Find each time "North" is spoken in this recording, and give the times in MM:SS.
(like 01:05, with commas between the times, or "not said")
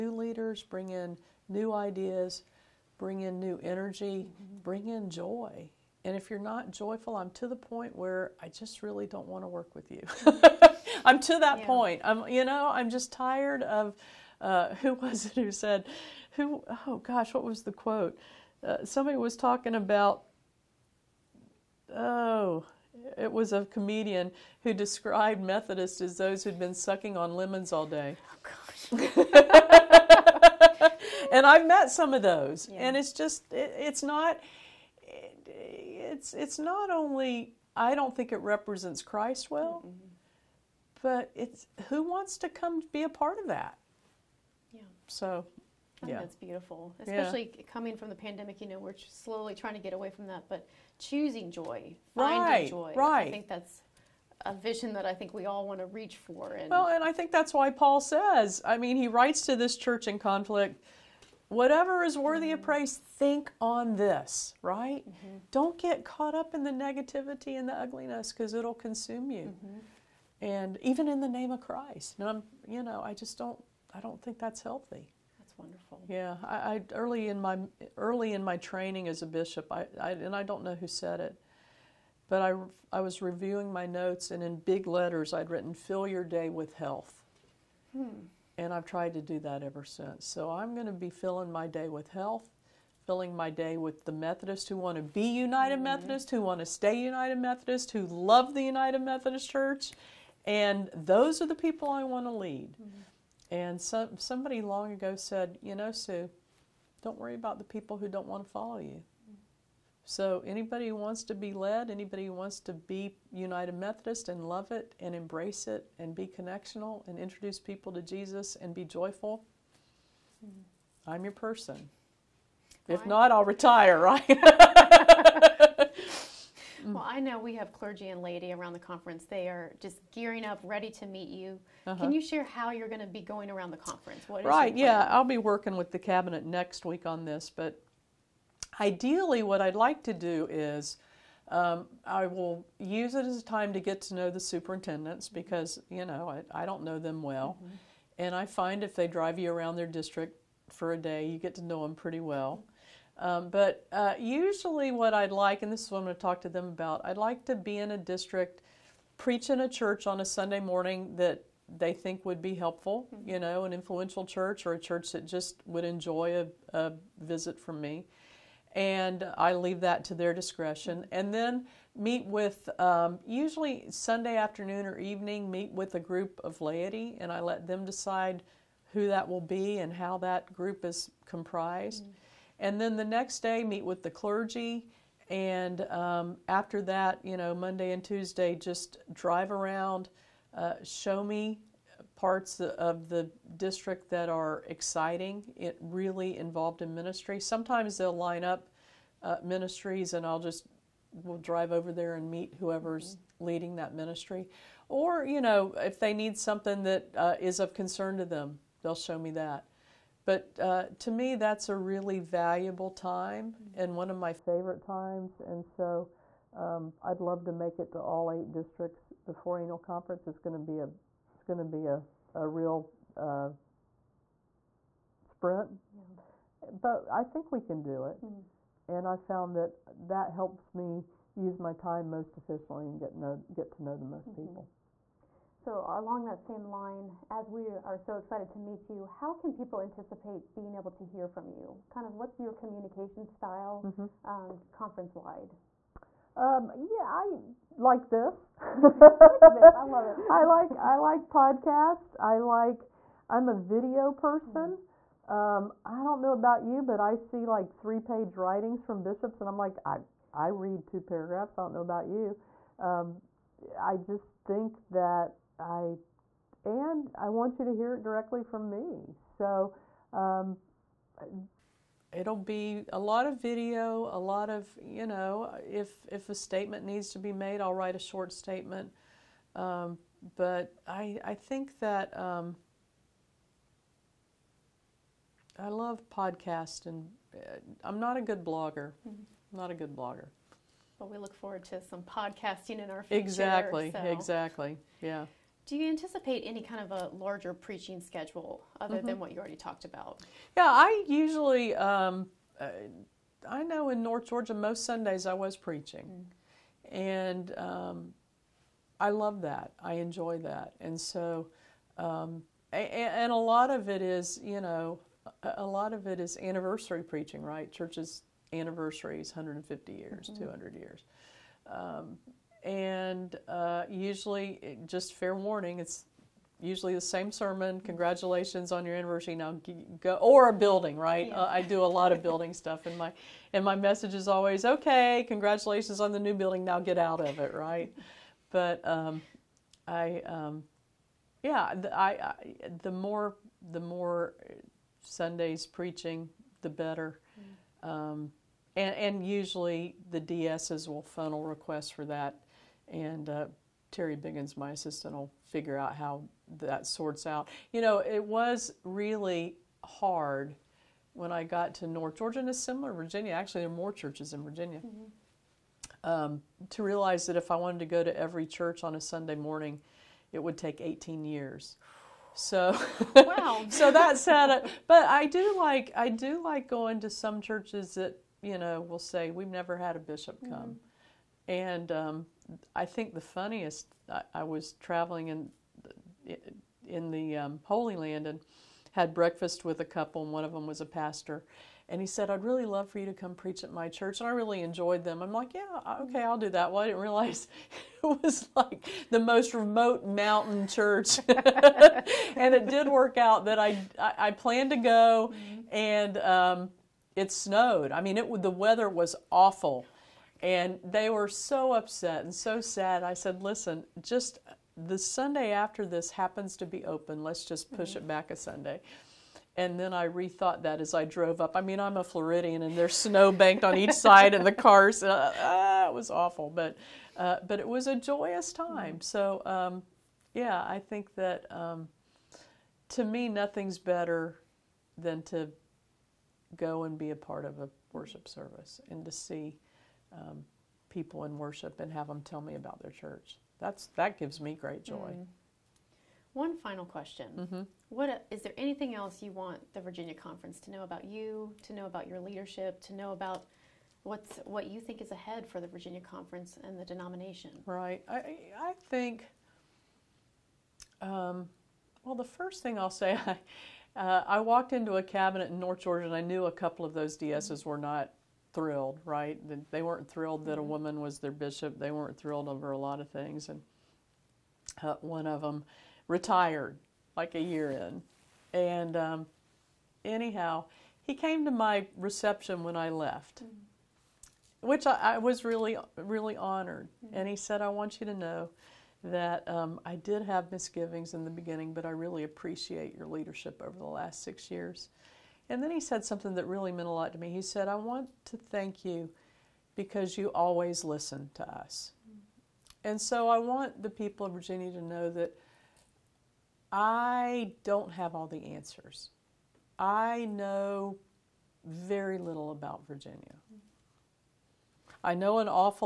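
05:04, 06:01, 07:45.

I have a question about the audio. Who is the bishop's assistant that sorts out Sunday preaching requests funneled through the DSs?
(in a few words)
Terry Biggins.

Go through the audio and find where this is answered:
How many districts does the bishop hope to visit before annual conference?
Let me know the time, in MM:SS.
03:38.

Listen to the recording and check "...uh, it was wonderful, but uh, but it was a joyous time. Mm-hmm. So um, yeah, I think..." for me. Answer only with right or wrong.
wrong.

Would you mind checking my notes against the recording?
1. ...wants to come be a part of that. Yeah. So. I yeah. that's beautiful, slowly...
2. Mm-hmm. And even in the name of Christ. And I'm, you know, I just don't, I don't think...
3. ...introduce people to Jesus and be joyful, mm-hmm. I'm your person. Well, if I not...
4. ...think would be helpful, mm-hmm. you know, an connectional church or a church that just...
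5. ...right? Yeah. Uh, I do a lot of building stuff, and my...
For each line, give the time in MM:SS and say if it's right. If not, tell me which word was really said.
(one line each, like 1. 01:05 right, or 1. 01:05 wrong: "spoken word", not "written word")
1. 00:42 wrong: "especially", not "slowly"
2. 01:09 right
3. 01:57 right
4. 02:41 wrong: "influential", not "connectional"
5. 05:30 right.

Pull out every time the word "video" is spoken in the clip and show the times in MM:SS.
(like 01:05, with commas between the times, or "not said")
04:13, 04:33.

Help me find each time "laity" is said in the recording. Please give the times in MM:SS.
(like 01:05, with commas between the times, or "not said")
02:08, 02:56.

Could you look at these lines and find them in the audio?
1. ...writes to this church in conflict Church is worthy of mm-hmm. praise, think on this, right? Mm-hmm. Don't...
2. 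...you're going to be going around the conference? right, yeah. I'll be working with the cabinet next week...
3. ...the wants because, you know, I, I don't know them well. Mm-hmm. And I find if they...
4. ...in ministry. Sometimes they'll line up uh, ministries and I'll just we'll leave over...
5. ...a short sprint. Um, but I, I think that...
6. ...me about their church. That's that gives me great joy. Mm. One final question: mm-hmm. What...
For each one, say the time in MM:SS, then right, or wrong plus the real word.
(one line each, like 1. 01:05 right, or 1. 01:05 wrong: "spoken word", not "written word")
1. 00:59 wrong: "Whatever", not "Church"
2. 02:12 right
3. 02:24 wrong: "superintendents", not "wants"
4. 03:16 wrong: "drive", not "leave"
5. 04:37 wrong: "statement", not "sprint"
6. 07:22 right.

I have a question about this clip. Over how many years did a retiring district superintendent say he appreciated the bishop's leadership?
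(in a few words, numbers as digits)
6.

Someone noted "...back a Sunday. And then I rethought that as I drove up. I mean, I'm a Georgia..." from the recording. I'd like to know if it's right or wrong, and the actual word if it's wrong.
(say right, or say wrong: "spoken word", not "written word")
wrong: "Floridian", not "Georgia".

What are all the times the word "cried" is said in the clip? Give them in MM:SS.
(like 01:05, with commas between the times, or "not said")
not said.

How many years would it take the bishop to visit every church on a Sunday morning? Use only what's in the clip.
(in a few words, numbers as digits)
18.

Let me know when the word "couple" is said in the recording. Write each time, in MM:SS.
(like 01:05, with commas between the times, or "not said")
06:29, 07:46.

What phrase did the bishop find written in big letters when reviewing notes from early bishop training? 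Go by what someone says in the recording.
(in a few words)
Fill your day with health.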